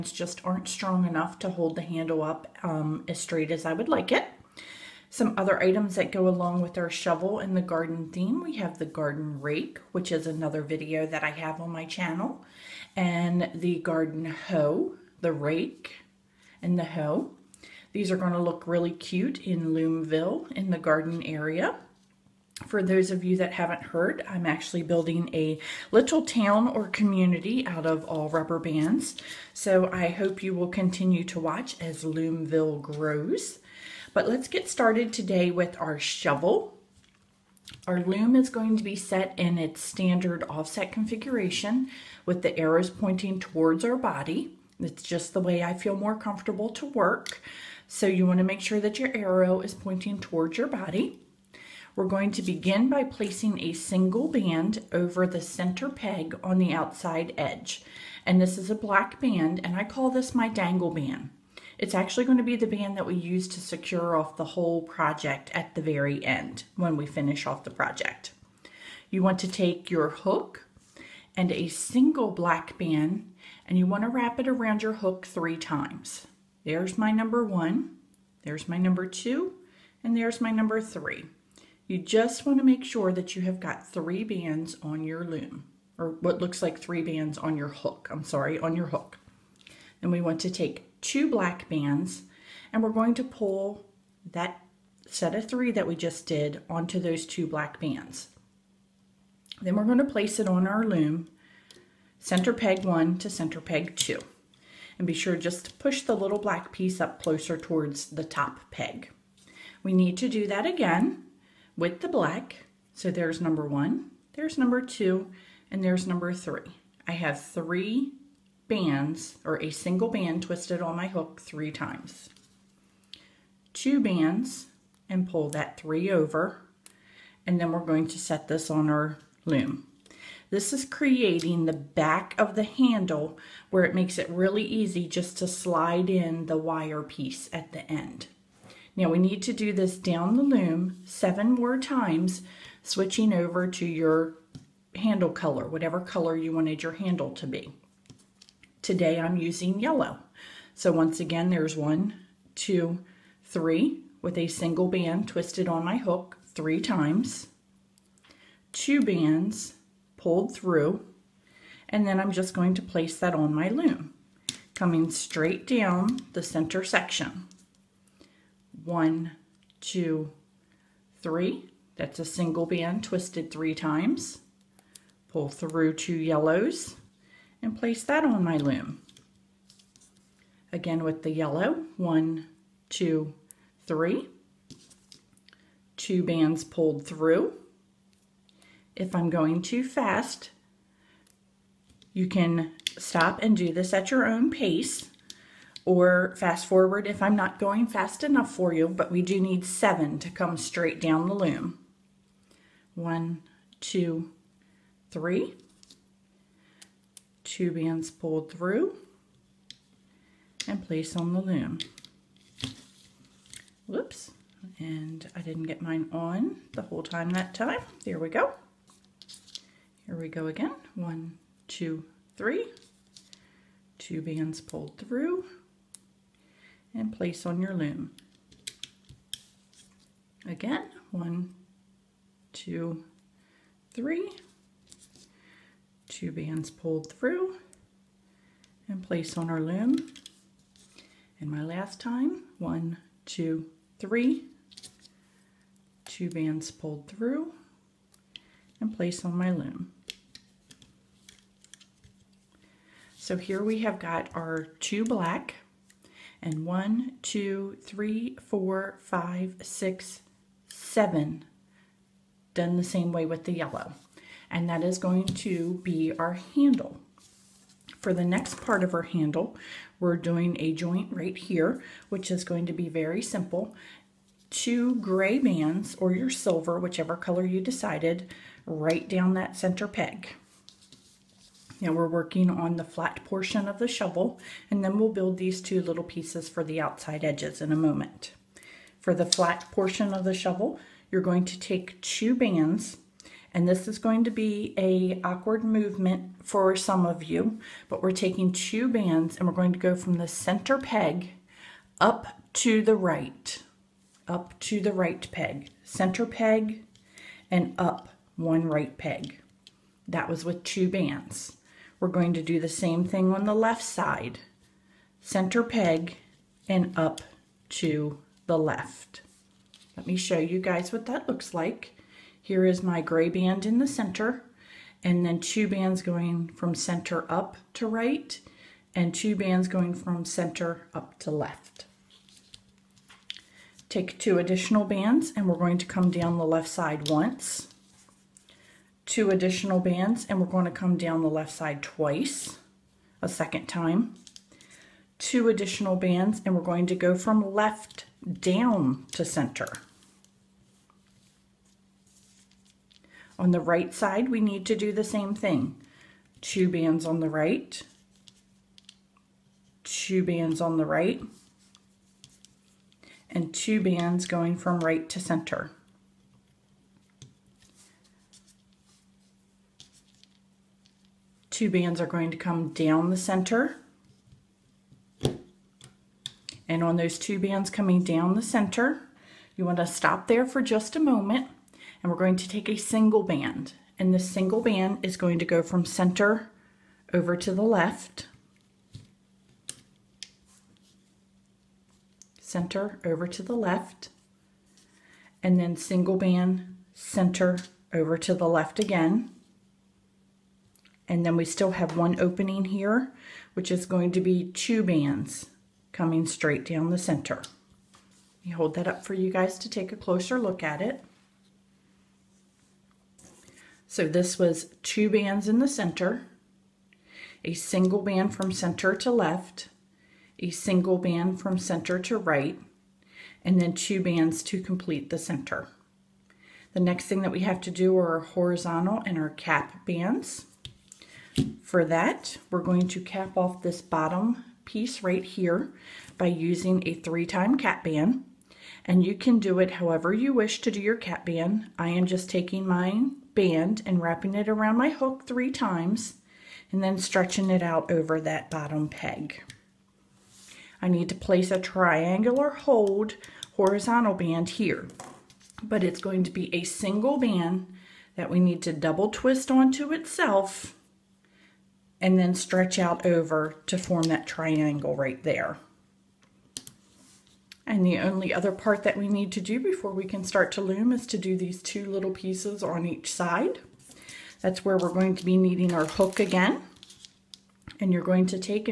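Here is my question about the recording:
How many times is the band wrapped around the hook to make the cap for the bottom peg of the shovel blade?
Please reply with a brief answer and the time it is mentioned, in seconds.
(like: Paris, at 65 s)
3, at 436 s.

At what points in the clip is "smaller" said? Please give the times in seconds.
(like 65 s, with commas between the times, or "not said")
not said.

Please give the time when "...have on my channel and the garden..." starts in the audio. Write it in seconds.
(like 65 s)
11 s.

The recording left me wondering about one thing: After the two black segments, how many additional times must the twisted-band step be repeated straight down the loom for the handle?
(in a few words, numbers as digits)
7.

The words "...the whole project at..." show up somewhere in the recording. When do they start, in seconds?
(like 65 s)
64 s.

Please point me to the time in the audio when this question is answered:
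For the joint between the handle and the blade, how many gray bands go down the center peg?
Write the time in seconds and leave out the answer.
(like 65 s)
274 s.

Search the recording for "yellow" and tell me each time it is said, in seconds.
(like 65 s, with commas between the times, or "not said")
149 s, 176 s, 181 s, 263 s.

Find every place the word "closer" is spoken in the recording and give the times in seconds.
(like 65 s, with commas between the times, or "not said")
107 s, 409 s.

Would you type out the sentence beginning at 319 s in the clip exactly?
Let me show you guys what that looks like.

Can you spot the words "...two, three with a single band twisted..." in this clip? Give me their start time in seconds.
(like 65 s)
152 s.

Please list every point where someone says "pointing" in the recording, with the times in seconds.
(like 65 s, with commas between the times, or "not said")
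42 s, 49 s.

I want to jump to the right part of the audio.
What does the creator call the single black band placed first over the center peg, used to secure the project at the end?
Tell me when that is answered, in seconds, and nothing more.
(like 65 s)
60 s.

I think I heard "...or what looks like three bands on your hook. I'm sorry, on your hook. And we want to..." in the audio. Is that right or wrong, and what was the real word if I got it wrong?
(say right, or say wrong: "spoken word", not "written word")
right.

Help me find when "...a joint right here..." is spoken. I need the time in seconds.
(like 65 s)
270 s.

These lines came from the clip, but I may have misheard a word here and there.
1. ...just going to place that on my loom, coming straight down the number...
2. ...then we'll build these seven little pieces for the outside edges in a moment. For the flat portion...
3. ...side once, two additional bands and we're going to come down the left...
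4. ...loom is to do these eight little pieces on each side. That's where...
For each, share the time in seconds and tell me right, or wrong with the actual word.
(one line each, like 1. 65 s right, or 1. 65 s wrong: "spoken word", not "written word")
1. 162 s wrong: "center", not "number"
2. 284 s wrong: "two", not "seven"
3. 336 s right
4. 470 s wrong: "two", not "eight".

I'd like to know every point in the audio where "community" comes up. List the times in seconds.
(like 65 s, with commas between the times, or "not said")
26 s.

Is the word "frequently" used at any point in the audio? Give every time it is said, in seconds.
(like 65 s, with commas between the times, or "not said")
not said.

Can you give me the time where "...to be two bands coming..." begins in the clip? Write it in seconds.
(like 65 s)
404 s.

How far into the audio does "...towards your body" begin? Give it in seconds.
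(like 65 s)
50 s.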